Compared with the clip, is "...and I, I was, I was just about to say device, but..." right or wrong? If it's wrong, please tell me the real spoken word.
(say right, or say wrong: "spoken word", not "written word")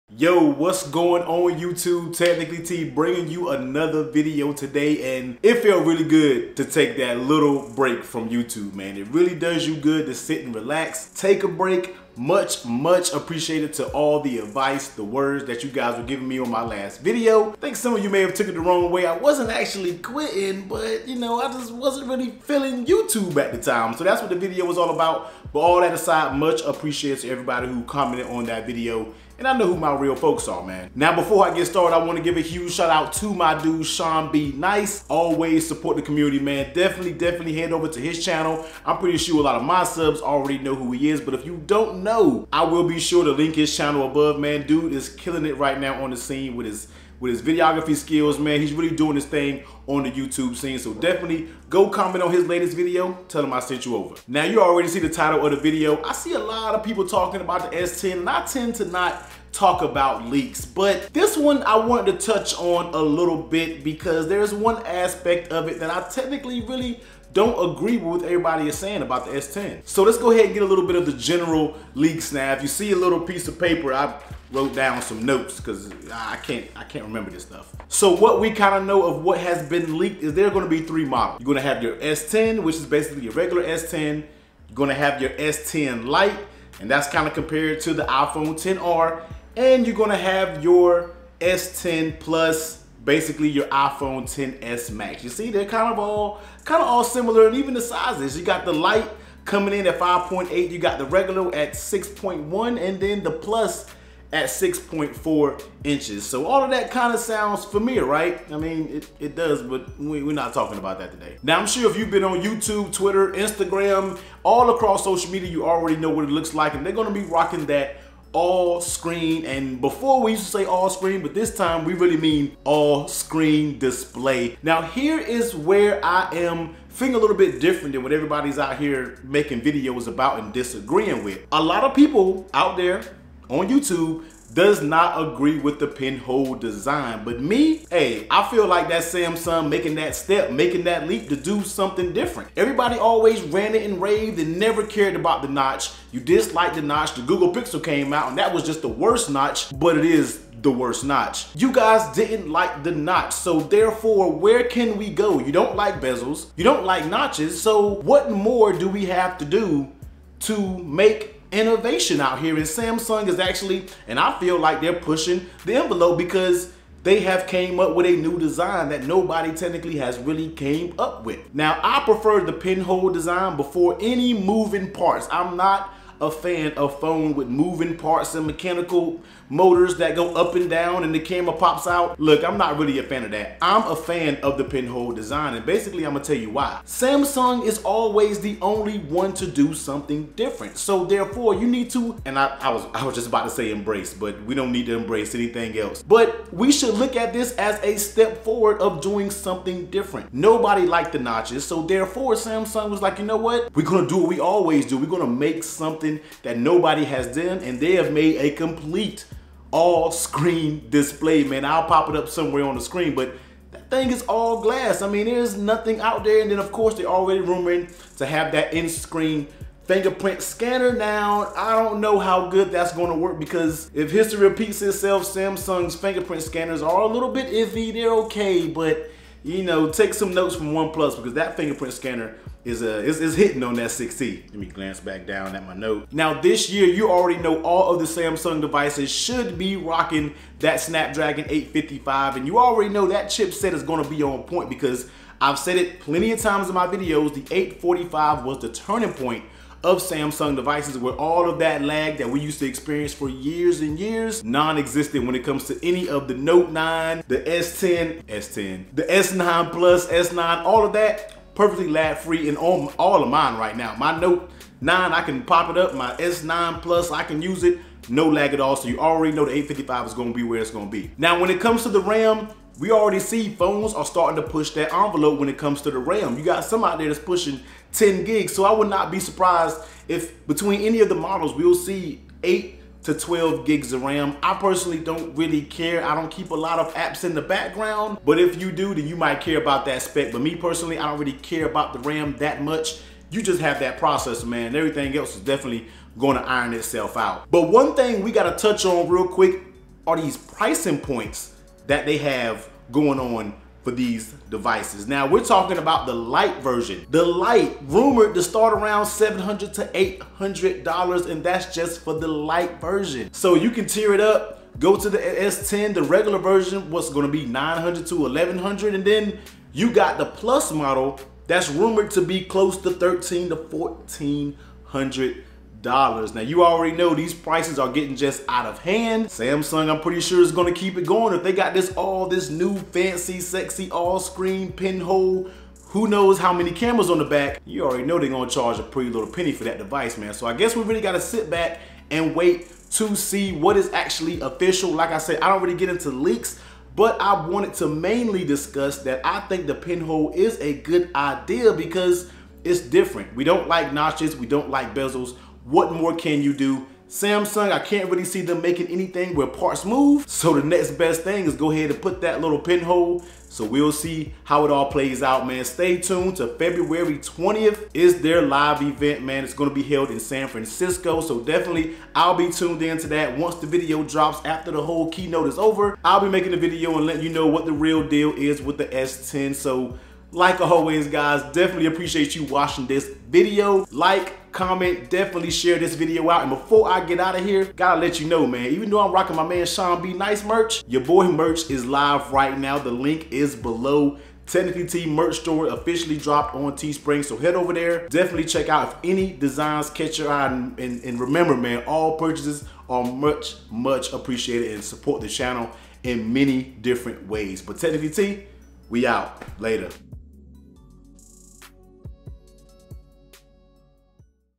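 wrong: "embrace", not "device".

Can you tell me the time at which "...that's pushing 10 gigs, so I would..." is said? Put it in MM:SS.
04:37.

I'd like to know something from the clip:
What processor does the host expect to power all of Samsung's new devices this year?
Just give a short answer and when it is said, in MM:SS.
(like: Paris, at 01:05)
Snapdragon 855, at 04:00.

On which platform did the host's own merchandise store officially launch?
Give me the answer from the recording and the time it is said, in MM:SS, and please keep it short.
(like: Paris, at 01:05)
Teespring, at 06:36.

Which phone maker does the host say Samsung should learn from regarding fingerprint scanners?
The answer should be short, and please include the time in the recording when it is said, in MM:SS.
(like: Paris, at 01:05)
OnePlus, at 03:50.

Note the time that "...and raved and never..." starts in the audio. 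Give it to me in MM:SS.
02:23.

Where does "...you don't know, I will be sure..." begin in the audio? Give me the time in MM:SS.
00:41.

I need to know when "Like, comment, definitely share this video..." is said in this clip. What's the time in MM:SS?
06:23.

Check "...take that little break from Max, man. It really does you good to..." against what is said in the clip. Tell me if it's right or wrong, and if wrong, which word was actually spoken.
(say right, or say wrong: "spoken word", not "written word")
wrong: "YouTube", not "Max".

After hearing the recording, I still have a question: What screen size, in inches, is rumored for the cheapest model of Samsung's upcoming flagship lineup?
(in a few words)
5.8.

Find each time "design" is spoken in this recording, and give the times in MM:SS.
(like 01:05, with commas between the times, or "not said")
02:16, 02:48, 02:53, 03:05, 06:39.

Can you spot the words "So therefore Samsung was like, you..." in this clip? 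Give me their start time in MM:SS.
03:21.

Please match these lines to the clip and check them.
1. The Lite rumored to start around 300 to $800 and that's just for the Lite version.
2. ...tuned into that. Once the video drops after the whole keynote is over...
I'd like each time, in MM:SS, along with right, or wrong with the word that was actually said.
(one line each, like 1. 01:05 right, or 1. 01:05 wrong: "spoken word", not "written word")
1. 05:07 wrong: "700", not "300"
2. 06:12 right.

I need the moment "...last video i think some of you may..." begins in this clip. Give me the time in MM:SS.
00:16.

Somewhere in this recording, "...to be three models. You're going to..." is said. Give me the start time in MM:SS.
01:20.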